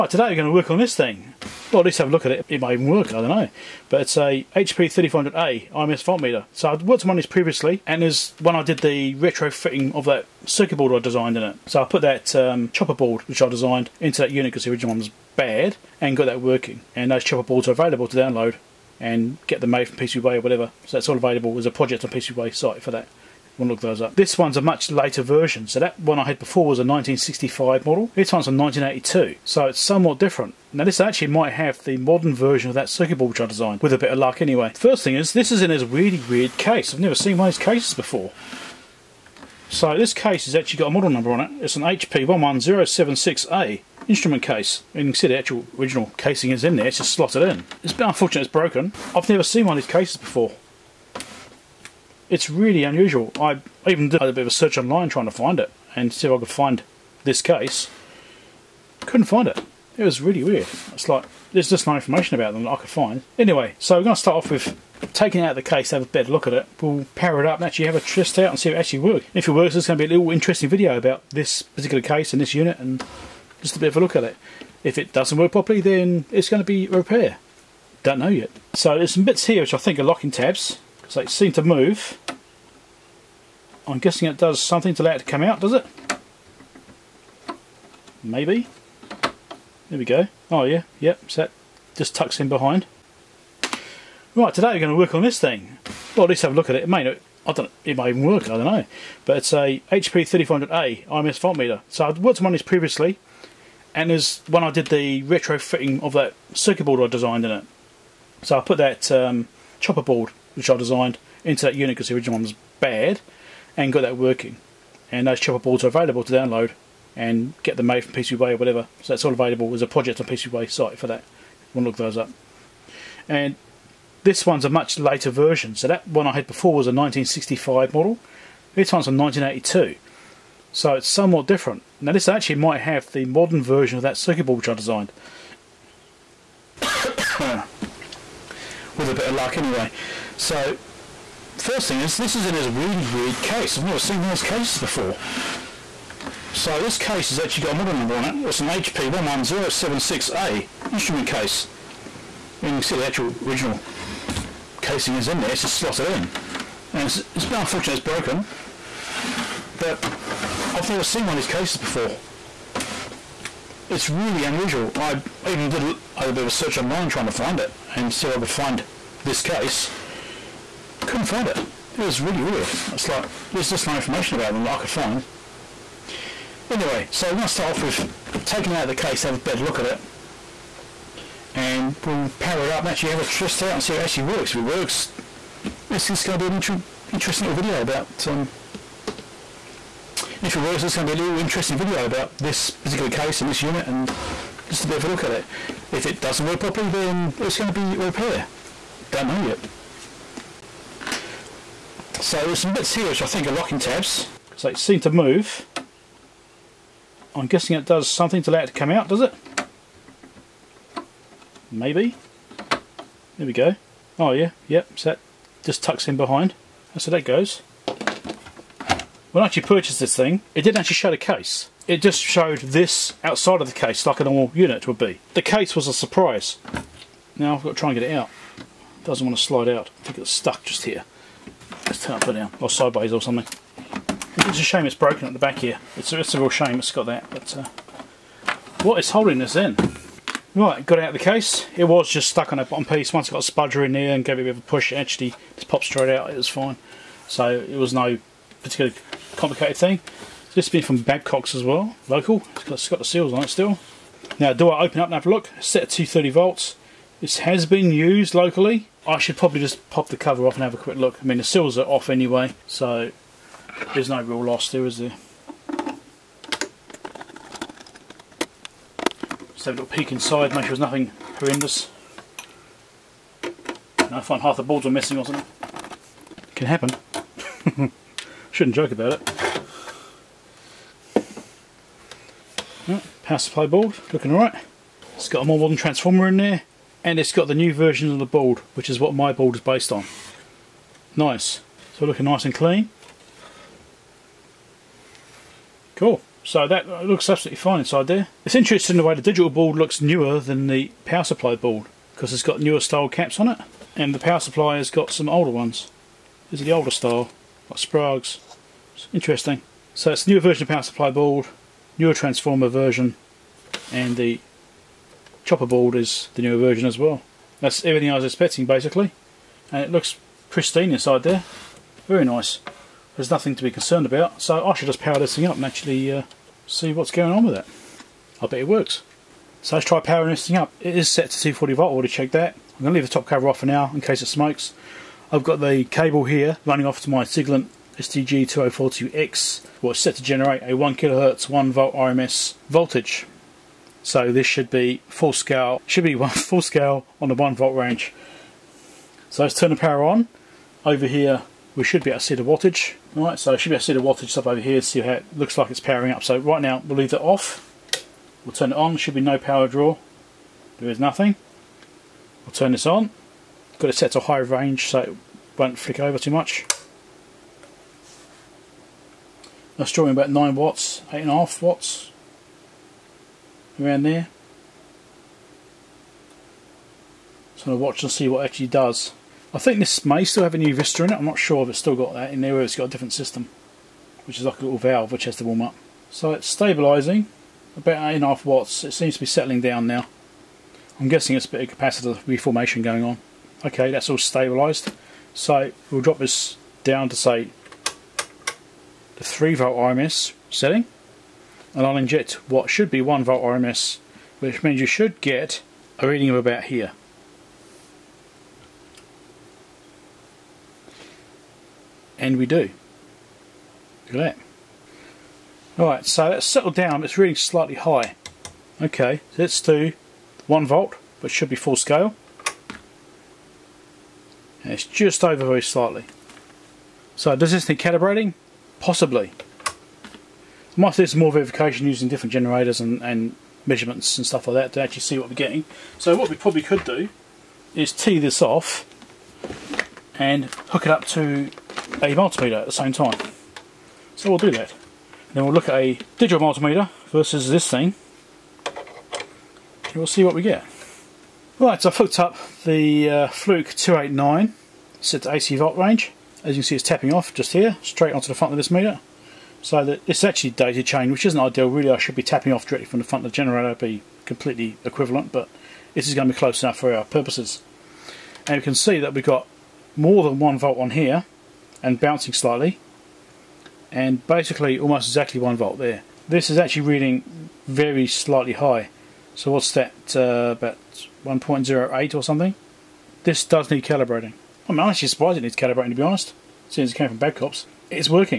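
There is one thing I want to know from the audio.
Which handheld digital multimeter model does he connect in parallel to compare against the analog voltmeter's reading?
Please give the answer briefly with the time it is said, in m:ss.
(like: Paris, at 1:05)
Fluke 289, at 7:33.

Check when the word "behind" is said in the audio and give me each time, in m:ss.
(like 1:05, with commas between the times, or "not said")
1:32, 3:36.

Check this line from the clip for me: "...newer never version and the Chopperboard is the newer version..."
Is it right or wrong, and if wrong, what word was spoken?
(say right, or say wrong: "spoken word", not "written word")
wrong: "transformer", not "never".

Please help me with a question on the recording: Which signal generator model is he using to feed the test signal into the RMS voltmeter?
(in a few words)
Siglent SDG2042X.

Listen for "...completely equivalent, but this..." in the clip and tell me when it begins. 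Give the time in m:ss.
7:44.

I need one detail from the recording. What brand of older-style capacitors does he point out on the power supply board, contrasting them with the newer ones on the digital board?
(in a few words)
Sprague.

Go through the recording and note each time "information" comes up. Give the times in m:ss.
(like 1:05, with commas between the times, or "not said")
1:01, 2:53.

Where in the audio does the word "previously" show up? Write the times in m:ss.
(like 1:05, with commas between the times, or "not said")
0:07, 1:42.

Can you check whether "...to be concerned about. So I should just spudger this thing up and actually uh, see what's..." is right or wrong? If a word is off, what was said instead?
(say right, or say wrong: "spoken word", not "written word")
wrong: "power", not "spudger".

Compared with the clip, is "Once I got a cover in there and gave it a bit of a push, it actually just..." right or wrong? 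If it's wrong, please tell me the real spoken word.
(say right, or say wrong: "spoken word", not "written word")
wrong: "spudger", not "cover".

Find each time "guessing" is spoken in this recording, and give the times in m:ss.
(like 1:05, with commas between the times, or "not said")
1:23, 3:27, 6:31.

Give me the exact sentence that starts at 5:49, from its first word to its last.
So let's turn the power on.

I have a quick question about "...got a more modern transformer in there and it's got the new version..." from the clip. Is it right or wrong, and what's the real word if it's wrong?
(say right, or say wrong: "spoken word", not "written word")
right.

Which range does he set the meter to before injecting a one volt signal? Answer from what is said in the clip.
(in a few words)
3 volt RMS.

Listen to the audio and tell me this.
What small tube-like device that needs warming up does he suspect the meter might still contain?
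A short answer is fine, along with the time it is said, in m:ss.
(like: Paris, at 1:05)
Nuvistor, at 6:20.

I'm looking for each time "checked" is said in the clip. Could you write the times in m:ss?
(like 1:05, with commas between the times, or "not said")
5:32.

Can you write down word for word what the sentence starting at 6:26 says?
So it's stabilising, about 8.5 watts.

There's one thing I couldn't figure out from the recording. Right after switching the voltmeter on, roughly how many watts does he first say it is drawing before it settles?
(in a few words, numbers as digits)
9 watts.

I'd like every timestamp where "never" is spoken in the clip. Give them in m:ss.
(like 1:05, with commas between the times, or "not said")
0:36, 0:49, 2:23, 2:40.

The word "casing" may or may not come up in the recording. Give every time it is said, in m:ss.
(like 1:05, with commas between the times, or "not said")
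0:46, 2:34.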